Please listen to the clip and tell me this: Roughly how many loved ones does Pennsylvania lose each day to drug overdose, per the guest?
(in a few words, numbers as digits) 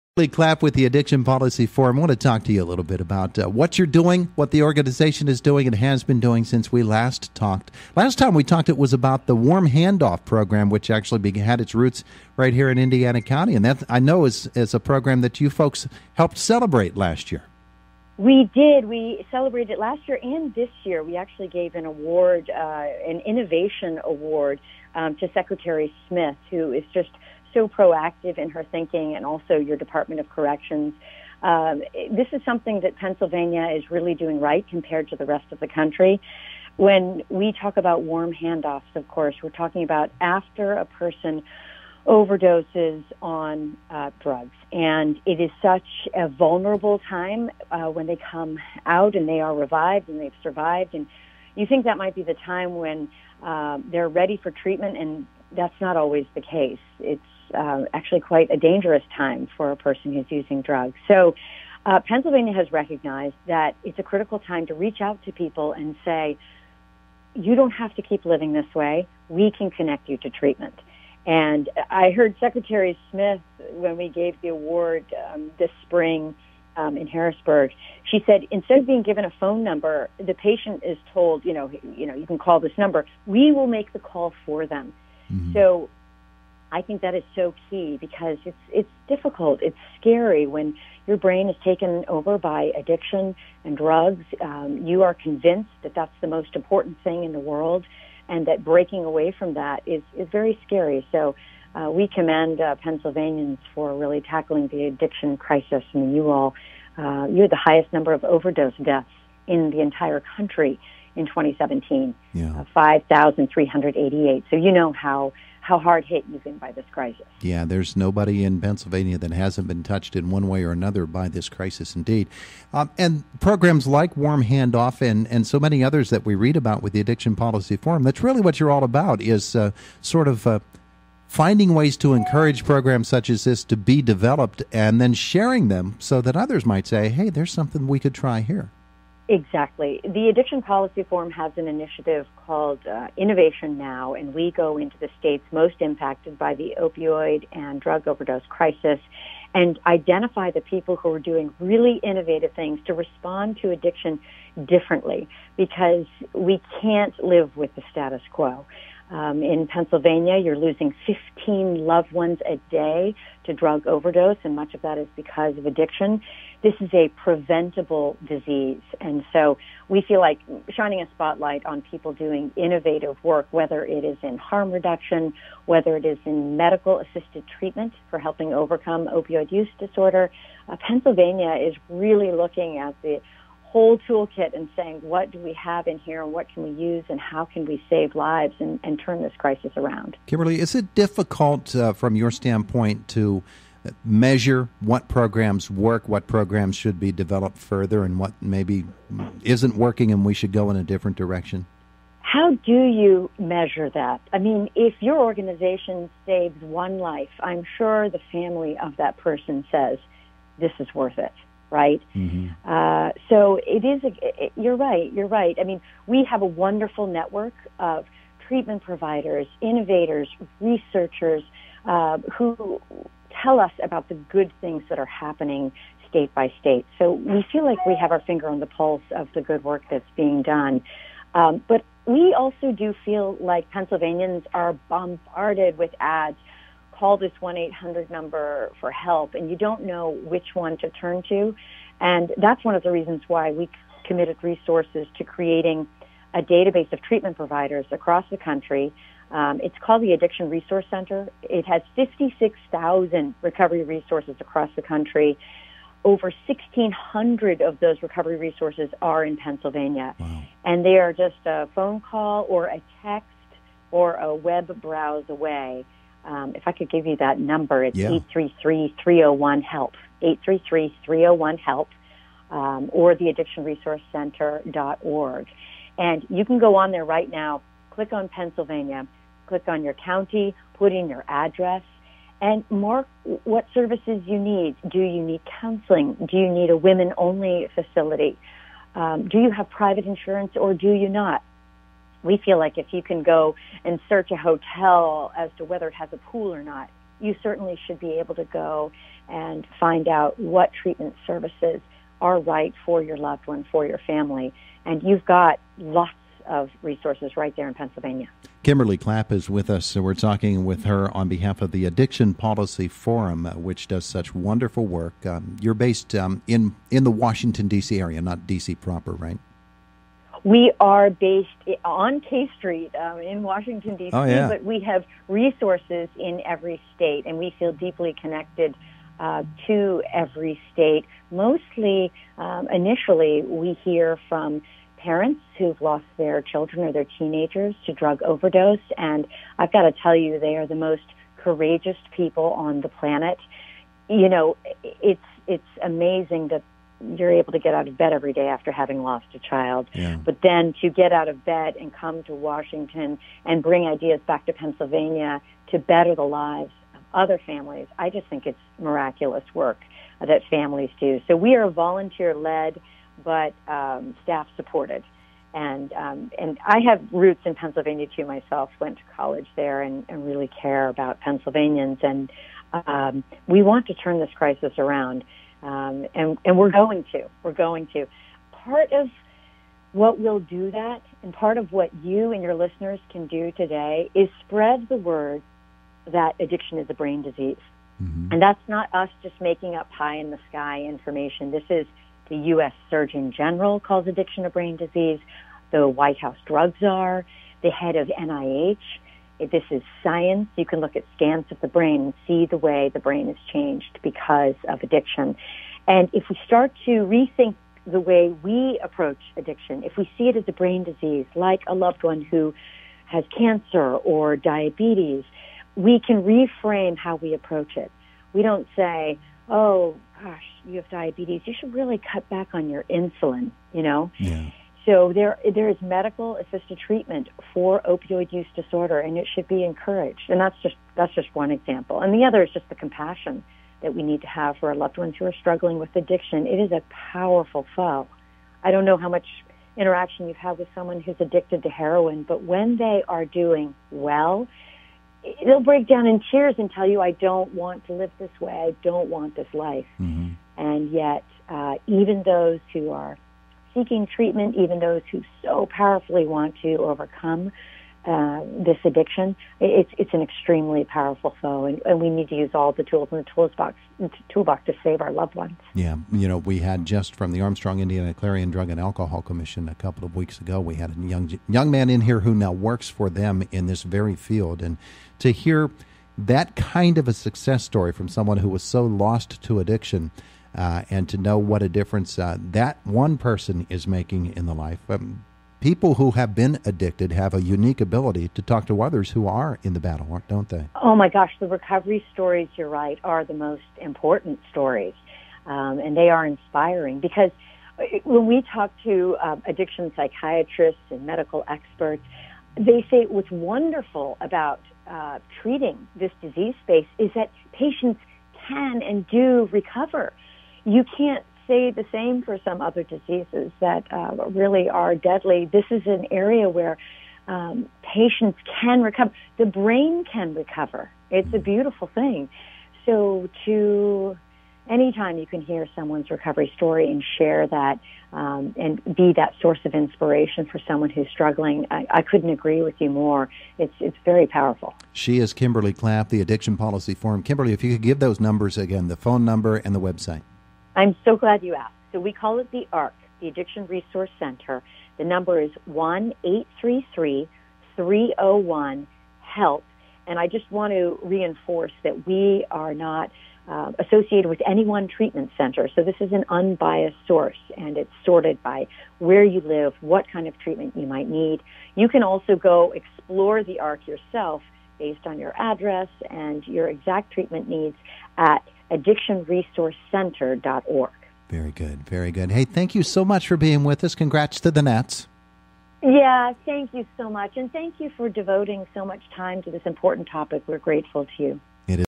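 15.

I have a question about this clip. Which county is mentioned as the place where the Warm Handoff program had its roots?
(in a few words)
Indiana County.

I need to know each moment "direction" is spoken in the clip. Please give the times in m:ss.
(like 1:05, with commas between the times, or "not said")
3:21.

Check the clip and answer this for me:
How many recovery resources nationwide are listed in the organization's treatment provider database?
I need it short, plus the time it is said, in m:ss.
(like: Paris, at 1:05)
56,000, at 4:11.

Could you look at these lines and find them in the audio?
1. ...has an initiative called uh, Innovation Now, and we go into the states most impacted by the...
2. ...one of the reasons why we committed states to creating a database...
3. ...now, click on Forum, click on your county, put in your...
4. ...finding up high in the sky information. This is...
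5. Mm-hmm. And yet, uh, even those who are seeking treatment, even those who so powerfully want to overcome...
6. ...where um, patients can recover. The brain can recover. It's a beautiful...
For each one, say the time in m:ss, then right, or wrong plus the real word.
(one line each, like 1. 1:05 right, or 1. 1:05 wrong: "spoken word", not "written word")
1. 2:21 right
2. 4:02 wrong: "resources", not "states"
3. 4:37 wrong: "Pennsylvania", not "Forum"
4. 6:29 wrong: "making", not "finding"
5. 7:29 right
6. 8:36 right.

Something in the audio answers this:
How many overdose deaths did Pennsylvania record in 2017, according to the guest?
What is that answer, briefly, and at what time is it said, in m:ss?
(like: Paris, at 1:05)
5,388, at 1:52.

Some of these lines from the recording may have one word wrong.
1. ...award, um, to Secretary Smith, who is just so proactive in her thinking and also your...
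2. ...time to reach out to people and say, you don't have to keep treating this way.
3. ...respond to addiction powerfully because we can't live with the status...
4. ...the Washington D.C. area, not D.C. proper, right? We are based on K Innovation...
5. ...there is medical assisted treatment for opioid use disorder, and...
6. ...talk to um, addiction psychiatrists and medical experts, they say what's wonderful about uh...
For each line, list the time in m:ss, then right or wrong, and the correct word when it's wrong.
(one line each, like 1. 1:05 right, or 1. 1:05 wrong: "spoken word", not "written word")
1. 0:24 right
2. 1:04 wrong: "living", not "treating"
3. 2:32 wrong: "differently", not "powerfully"
4. 5:17 wrong: "Street", not "Innovation"
5. 7:05 right
6. 8:18 right.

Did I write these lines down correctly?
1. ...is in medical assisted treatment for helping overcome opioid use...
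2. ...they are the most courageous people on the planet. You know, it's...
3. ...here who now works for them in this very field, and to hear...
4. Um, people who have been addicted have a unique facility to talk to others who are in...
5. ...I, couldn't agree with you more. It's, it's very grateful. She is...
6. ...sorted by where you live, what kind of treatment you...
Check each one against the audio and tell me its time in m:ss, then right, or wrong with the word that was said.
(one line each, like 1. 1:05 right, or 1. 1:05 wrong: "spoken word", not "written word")
1. 2:56 right
2. 5:40 right
3. 7:52 right
4. 8:04 wrong: "ability", not "facility"
5. 8:51 wrong: "powerful", not "grateful"
6. 9:18 right.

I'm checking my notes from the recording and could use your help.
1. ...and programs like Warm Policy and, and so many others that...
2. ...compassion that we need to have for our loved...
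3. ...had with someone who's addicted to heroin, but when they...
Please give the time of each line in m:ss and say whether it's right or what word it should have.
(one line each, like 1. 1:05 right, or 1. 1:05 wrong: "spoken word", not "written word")
1. 2:02 wrong: "Handoff", not "Policy"
2. 7:12 right
3. 7:20 right.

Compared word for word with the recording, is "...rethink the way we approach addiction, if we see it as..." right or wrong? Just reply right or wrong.
right.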